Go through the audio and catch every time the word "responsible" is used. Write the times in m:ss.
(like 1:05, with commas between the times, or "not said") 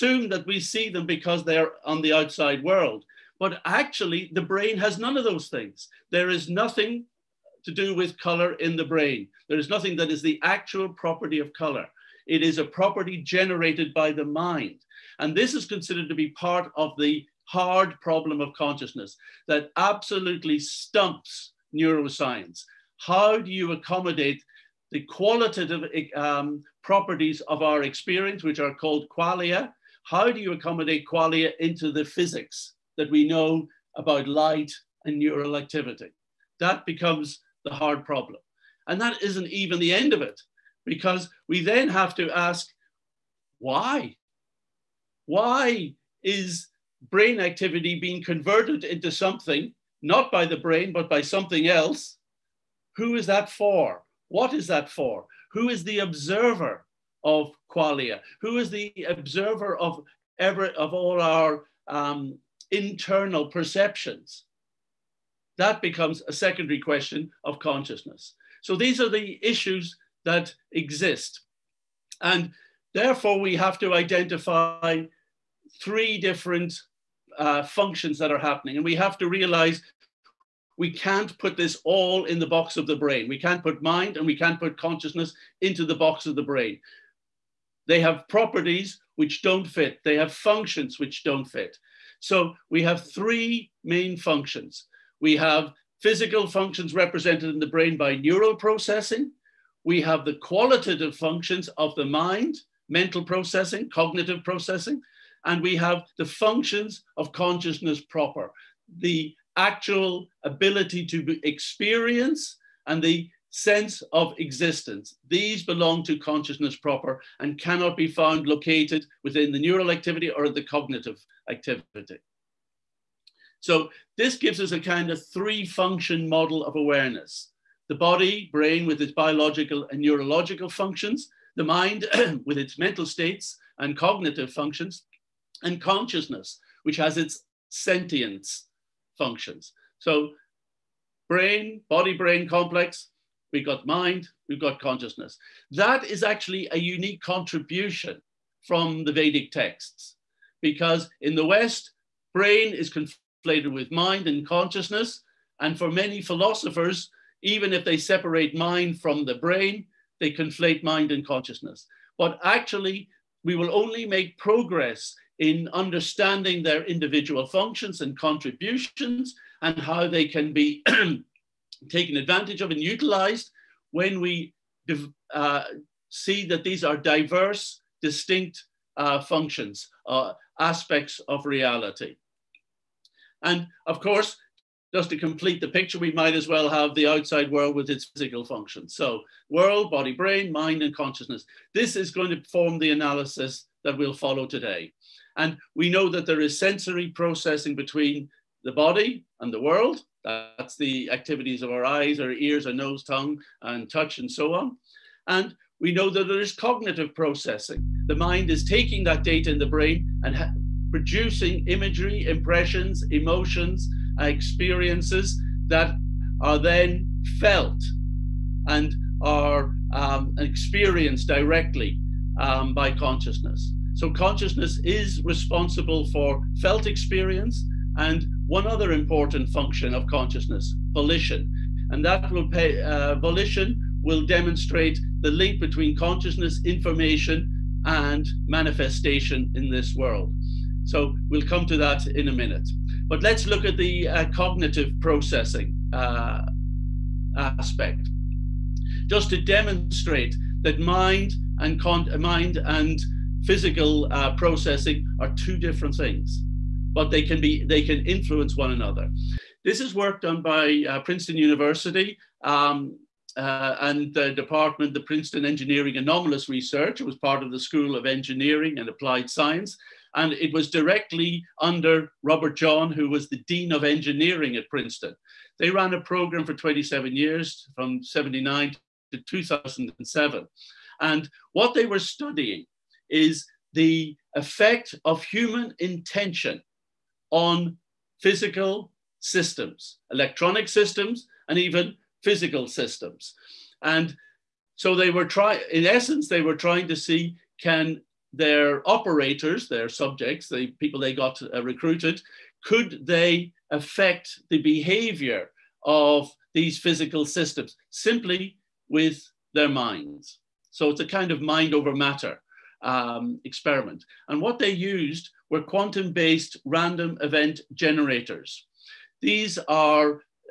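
3:45.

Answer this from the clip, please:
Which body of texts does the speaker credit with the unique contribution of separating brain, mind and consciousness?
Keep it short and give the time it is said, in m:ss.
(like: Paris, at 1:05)
The Vedic texts, at 2:29.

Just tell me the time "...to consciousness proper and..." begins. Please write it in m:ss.
1:56.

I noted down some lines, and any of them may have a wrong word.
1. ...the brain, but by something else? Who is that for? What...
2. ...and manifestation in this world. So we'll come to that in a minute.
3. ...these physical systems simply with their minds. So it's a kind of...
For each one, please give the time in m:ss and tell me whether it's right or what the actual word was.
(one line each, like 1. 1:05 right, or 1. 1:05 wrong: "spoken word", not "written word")
1. 0:50 right
2. 3:57 right
3. 5:06 right.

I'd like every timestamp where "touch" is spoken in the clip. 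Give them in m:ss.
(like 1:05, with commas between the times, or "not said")
3:23.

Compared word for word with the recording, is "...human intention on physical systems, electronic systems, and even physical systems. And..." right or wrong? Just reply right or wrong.
right.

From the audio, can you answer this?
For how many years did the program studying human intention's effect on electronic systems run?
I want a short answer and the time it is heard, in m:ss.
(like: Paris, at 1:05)
27, at 4:36.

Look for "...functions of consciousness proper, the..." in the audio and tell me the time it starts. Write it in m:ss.
1:46.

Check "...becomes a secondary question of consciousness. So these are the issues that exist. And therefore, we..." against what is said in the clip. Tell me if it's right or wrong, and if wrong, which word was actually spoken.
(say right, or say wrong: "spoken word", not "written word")
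right.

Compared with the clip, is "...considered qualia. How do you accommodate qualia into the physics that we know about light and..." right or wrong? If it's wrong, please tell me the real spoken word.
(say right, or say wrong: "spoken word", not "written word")
wrong: "called", not "considered".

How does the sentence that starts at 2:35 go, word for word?
And for many philosophers, even if they separate mind from the brain, they conflate mind and consciousness.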